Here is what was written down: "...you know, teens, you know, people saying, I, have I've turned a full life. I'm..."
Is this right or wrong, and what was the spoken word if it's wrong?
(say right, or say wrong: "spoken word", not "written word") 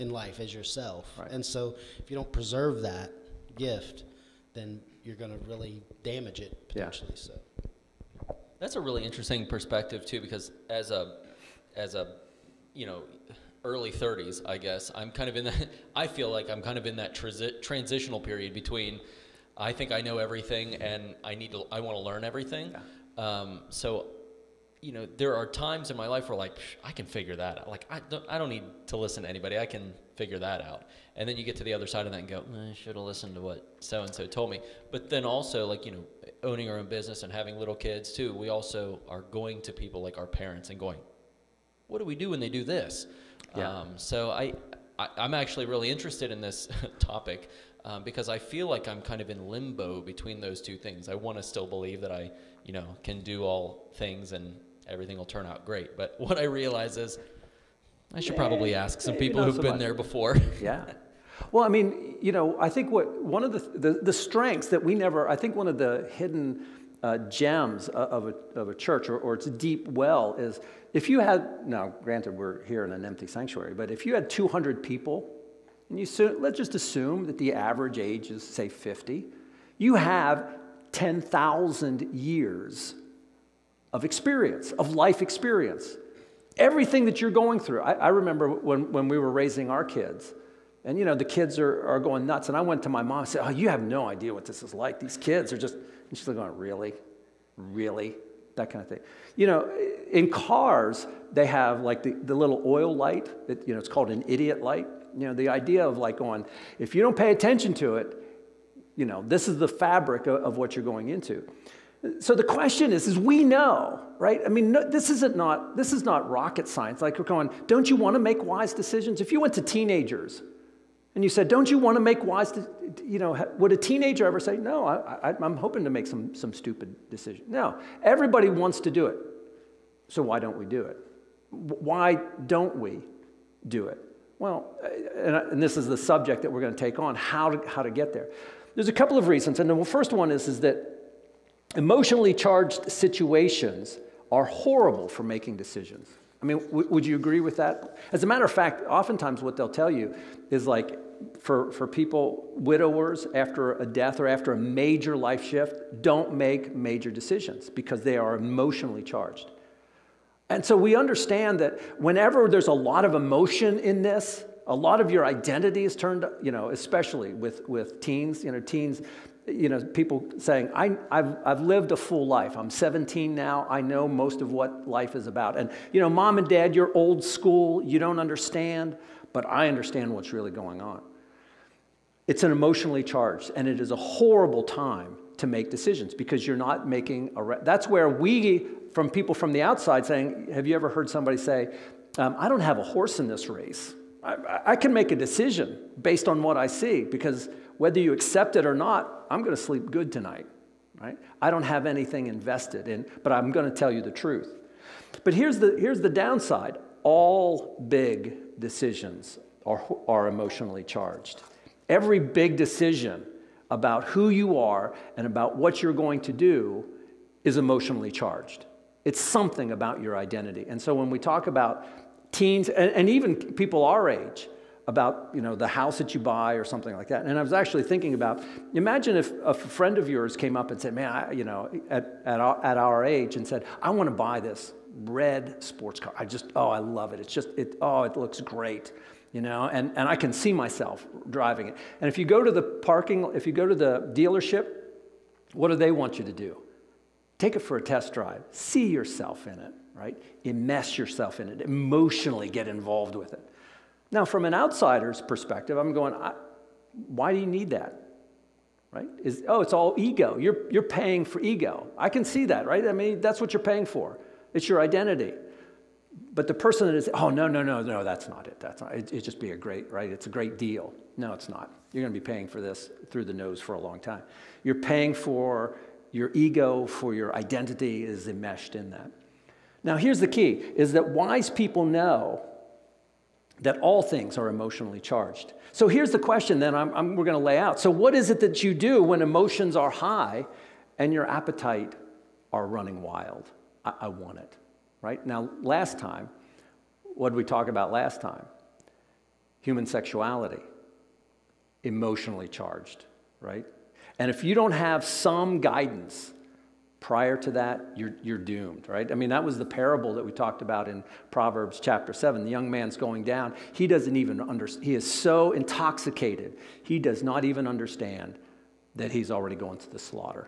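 wrong: "lived", not "turned".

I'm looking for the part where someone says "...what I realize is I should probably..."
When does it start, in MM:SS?
00:56.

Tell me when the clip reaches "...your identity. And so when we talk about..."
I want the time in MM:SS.
03:40.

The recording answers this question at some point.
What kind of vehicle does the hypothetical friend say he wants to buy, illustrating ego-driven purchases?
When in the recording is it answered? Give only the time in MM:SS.
03:55.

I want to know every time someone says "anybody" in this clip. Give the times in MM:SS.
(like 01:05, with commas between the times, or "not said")
00:29.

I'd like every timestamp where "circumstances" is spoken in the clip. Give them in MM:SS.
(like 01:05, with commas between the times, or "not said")
not said.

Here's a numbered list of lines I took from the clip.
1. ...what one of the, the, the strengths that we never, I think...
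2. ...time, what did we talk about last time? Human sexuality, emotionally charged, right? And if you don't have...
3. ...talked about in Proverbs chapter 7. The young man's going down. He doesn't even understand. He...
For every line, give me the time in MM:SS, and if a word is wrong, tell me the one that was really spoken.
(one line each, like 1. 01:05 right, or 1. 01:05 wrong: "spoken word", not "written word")
1. 01:02 right
2. 04:55 right
3. 05:10 right.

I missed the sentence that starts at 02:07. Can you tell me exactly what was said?
No, everybody wants to do it.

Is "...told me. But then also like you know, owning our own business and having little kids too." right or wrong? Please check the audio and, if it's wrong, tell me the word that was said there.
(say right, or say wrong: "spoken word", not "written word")
right.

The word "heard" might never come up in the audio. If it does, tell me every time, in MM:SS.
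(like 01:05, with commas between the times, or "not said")
03:10.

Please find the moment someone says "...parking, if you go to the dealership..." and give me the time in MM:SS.
04:02.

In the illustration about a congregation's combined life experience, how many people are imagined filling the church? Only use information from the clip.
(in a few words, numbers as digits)
200.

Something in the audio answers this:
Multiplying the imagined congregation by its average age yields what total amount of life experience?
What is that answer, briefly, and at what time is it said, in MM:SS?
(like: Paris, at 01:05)
10,000 years, at 01:20.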